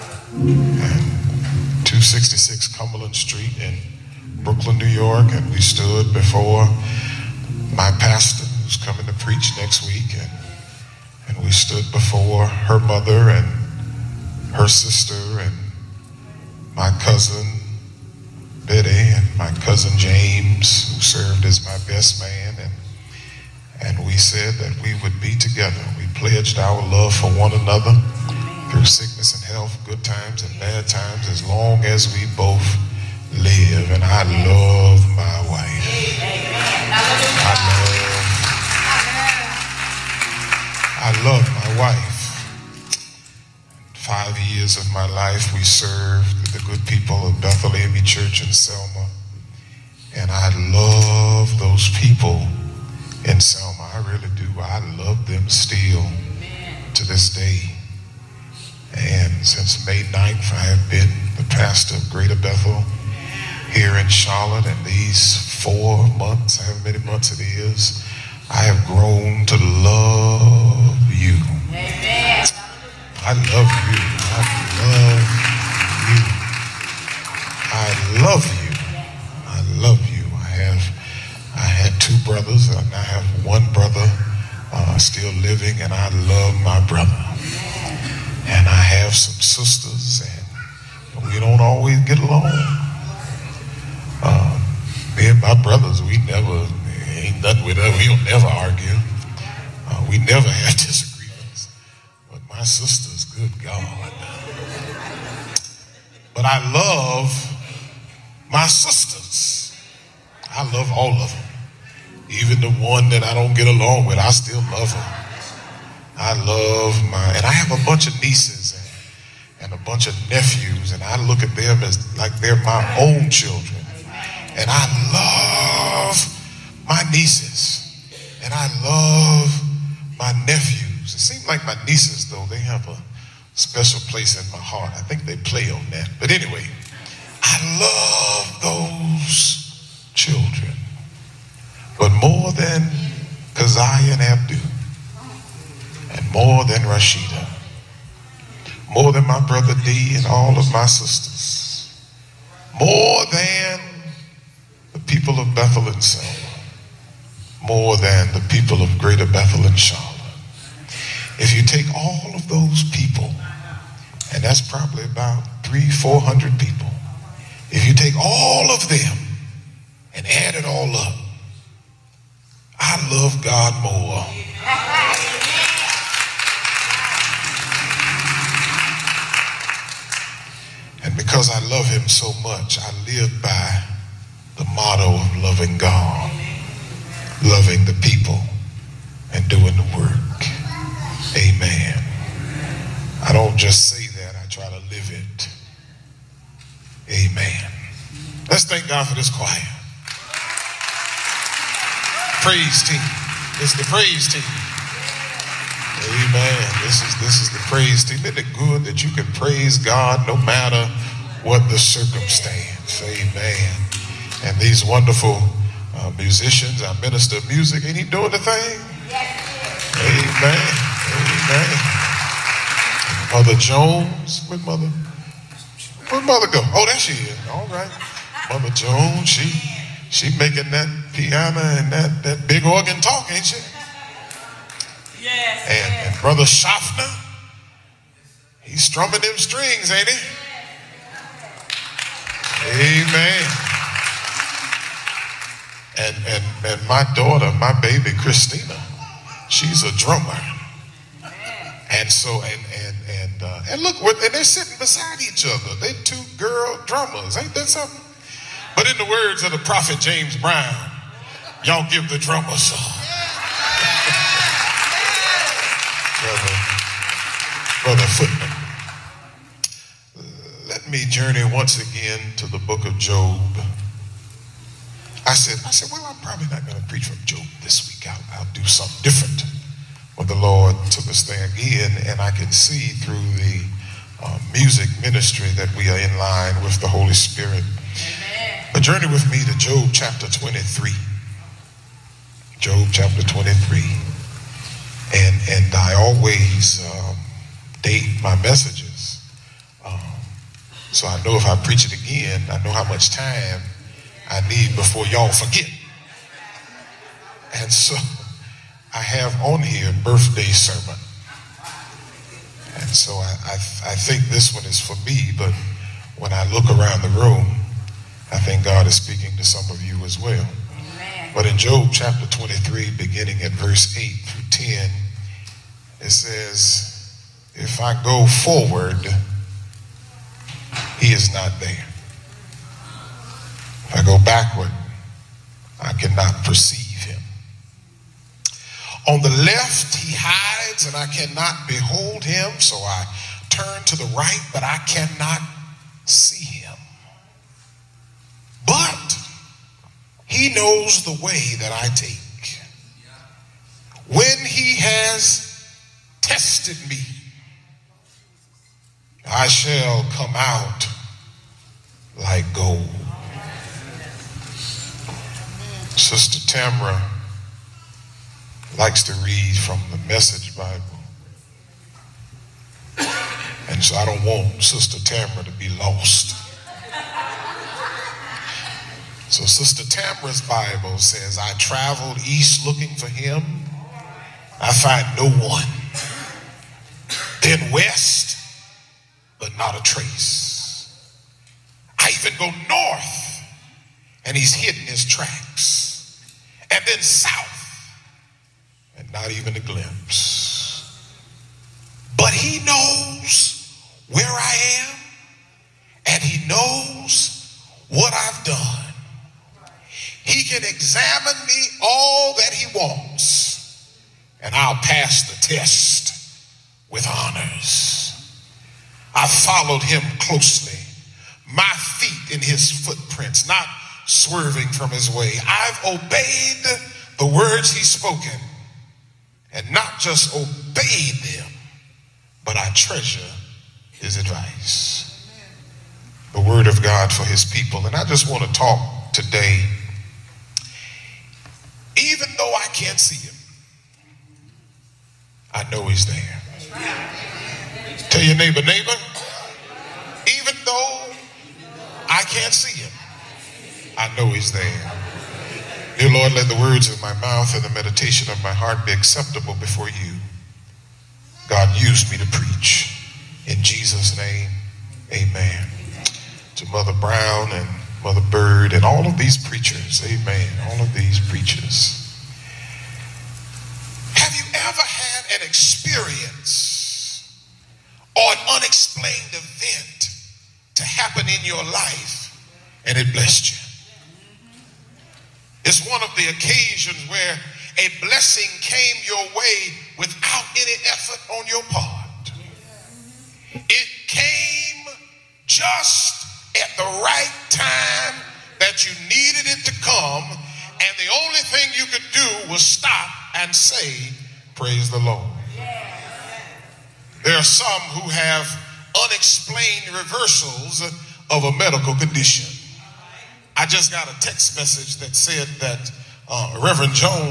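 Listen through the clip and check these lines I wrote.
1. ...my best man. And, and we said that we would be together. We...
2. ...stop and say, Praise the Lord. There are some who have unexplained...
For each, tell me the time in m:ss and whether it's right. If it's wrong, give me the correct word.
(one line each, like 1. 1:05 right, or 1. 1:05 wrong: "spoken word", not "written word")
1. 0:21 right
2. 8:22 right.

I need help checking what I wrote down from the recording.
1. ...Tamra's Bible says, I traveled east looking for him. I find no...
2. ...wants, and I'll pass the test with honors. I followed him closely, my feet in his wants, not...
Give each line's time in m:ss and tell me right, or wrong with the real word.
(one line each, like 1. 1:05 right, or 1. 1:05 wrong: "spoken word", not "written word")
1. 6:19 right
2. 6:52 wrong: "footprints", not "wants".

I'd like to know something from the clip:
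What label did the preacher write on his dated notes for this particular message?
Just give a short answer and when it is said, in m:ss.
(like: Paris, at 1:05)
Birthday sermon, at 5:10.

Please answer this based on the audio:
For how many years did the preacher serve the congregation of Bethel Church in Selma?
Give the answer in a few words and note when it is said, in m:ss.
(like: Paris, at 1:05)
5, at 0:43.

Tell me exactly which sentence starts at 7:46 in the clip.
To Mother Brown and Mother Bird and all of these preachers, amen.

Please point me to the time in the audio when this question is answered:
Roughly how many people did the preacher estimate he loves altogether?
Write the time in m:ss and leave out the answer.
2:45.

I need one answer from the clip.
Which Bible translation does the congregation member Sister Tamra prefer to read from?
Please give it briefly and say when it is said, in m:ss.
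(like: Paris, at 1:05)
The Message Bible, at 6:10.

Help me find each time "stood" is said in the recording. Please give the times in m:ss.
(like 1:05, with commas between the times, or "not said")
0:05, 0:11.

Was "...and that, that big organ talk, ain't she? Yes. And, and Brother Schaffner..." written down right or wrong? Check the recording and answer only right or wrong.
right.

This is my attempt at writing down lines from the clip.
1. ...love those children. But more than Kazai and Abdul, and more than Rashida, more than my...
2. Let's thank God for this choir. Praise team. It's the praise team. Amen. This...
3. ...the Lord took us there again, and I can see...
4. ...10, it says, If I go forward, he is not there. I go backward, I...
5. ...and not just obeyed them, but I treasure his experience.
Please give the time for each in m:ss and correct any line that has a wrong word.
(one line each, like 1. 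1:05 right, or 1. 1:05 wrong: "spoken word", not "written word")
1. 2:17 right
2. 3:18 right
3. 4:40 right
4. 5:24 right
5. 7:09 wrong: "advice", not "experience".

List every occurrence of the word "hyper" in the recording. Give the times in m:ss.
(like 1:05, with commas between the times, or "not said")
not said.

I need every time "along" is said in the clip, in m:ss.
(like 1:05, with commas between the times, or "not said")
1:32, 1:53.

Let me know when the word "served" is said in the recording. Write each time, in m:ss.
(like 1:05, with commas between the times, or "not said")
0:21, 0:45.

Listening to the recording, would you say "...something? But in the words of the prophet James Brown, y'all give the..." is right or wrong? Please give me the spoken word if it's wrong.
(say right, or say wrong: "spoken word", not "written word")
right.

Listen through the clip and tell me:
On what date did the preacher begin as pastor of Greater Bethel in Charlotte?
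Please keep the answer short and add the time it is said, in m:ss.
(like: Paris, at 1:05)
May 9th, at 0:59.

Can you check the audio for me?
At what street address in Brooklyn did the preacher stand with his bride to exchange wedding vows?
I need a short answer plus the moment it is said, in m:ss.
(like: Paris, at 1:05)
266 Cumberland Street, at 0:01.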